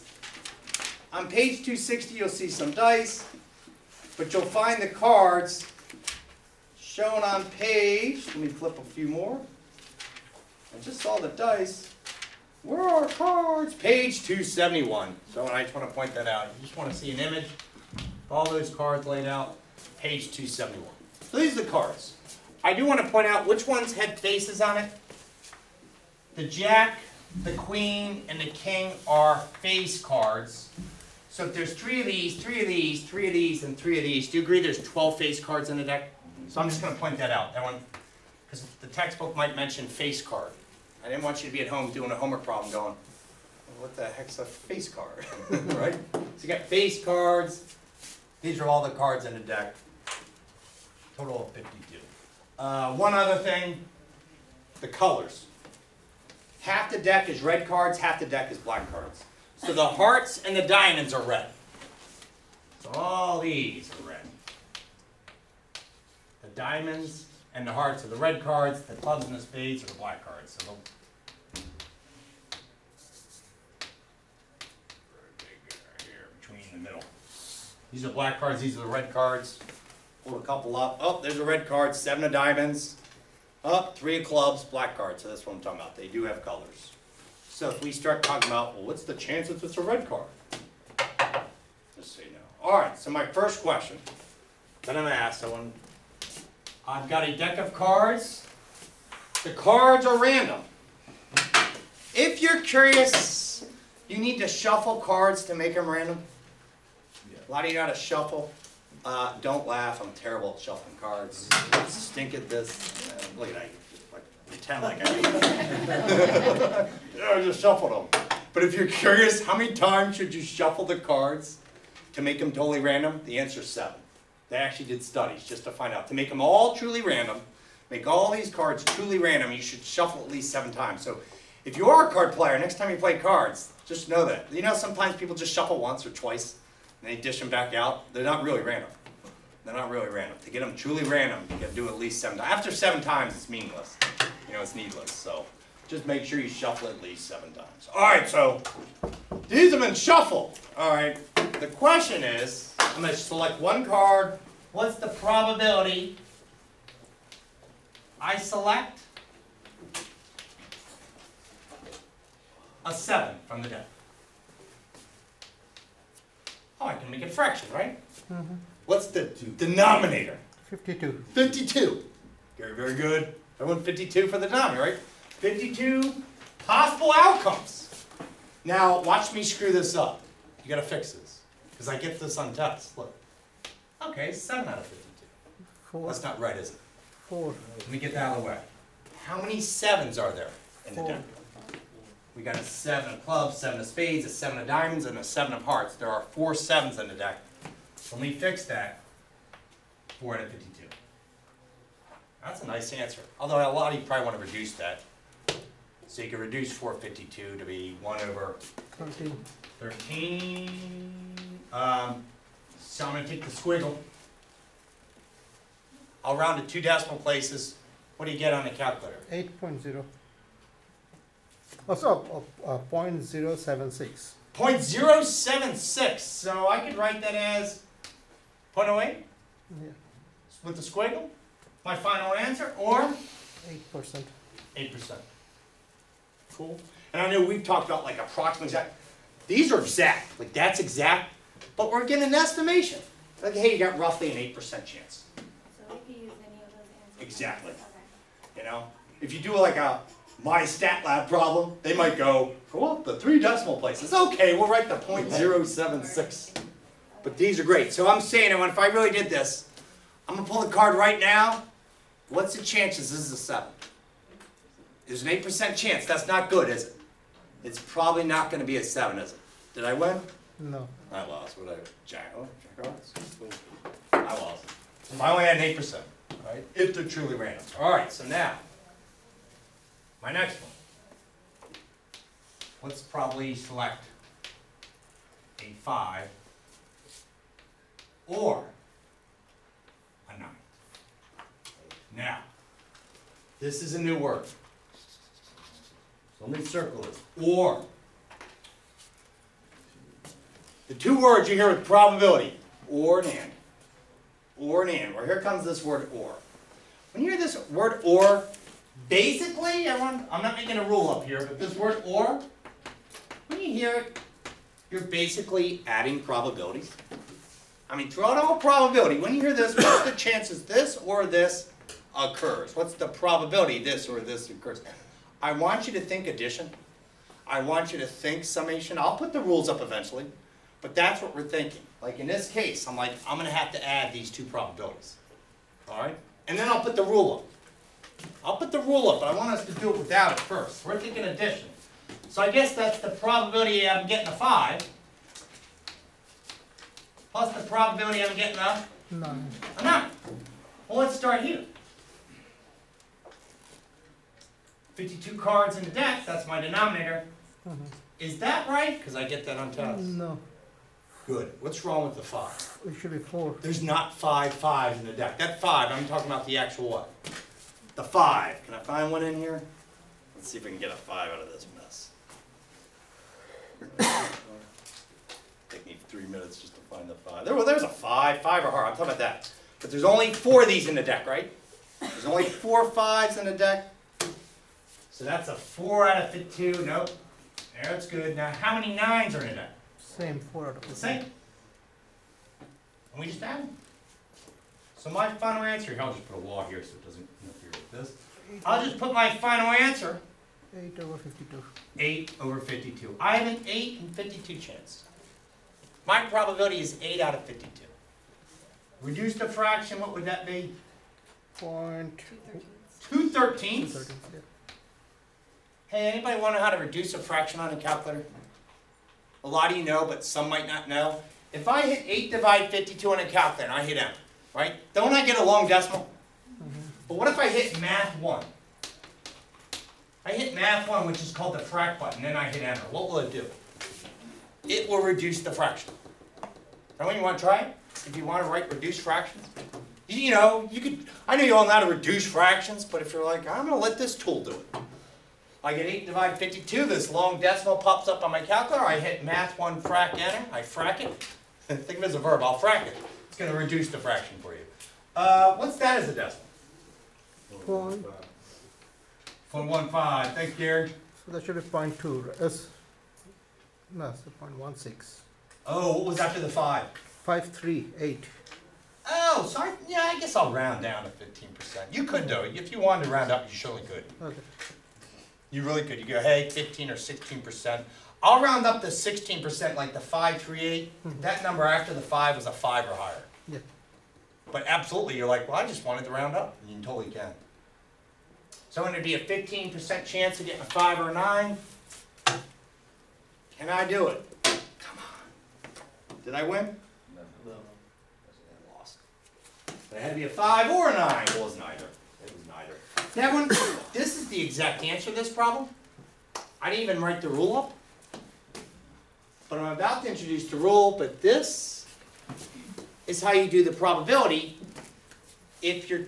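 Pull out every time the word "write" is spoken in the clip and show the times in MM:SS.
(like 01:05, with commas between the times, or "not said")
03:46, 04:14, 07:18, 08:27.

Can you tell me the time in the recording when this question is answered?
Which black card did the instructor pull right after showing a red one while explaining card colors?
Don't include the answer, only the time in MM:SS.
01:23.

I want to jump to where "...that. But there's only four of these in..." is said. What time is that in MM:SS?
06:19.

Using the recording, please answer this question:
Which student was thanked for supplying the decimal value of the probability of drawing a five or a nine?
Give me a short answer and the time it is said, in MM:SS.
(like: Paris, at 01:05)
Gary, at 07:40.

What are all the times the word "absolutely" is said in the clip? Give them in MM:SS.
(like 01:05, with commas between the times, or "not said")
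08:04.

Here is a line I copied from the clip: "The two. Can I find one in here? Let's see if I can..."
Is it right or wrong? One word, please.
wrong.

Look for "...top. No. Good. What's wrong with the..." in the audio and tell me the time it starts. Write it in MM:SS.
05:59.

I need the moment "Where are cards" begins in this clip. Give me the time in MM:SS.
00:12.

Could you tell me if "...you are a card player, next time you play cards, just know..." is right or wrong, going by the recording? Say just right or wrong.
right.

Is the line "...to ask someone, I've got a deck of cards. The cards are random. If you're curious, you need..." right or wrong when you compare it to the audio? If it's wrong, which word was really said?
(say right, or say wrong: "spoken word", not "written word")
right.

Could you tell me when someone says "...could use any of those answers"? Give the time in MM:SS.
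04:06.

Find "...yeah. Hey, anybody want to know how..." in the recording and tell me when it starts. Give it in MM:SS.
06:54.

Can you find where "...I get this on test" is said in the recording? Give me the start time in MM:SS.
03:01.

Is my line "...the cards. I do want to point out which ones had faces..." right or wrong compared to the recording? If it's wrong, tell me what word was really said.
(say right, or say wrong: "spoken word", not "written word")
right.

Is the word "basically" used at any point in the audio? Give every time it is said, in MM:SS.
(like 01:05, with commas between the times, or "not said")
05:09, 05:15.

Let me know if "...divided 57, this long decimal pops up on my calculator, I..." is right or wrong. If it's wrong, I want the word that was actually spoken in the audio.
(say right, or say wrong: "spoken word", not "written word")
wrong: "52", not "57".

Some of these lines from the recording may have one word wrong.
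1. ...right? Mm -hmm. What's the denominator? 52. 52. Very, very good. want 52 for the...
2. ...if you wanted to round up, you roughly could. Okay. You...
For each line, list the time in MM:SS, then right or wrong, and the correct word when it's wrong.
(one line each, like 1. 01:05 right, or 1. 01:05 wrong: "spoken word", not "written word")
1. 02:47 right
2. 07:52 wrong: "surely", not "roughly".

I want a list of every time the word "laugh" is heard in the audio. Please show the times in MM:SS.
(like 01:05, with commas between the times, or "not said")
01:49.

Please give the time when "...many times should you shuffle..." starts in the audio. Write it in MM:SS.
01:59.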